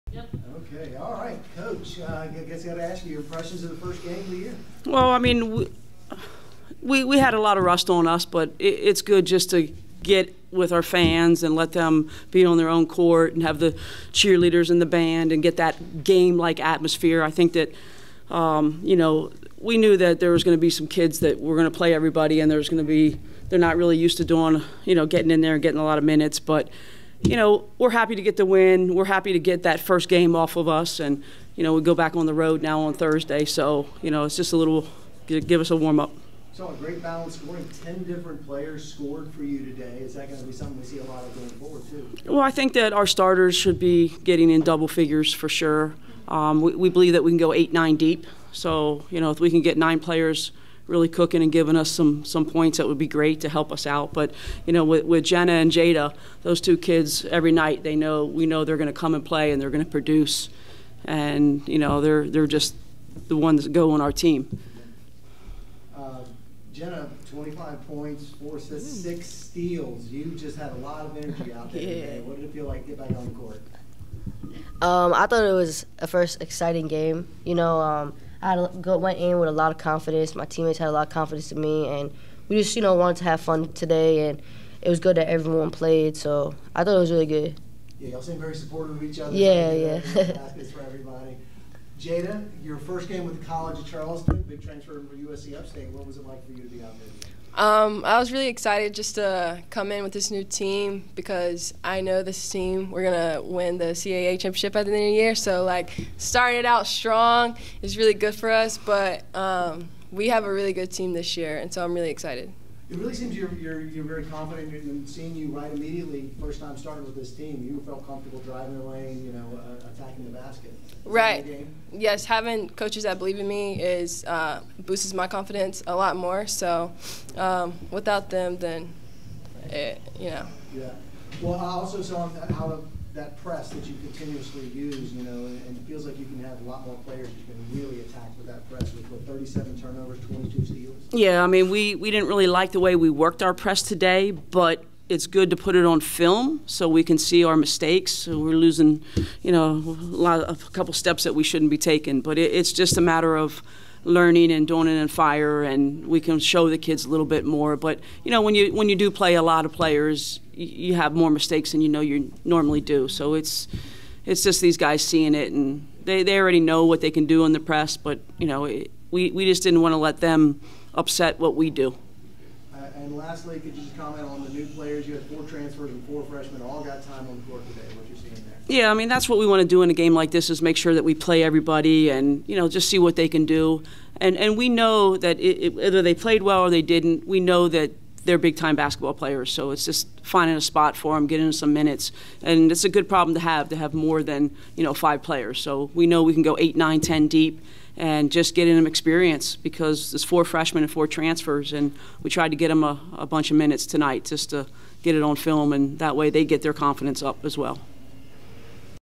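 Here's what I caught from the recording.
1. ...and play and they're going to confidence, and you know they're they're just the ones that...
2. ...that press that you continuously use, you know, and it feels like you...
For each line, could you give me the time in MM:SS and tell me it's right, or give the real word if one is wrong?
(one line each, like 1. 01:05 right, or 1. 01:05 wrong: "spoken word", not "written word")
1. 00:59 wrong: "produce", not "confidence"
2. 02:13 right.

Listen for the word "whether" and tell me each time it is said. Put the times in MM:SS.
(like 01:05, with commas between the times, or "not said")
03:05.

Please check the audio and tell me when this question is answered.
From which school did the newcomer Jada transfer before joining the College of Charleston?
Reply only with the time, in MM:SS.
01:35.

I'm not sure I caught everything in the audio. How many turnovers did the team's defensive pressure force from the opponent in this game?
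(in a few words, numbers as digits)
37.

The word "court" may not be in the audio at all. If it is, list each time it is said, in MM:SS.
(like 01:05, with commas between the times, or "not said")
00:12, 01:13, 02:57.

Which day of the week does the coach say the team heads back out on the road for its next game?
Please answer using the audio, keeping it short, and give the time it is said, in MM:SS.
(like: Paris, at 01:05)
Thursday, at 00:32.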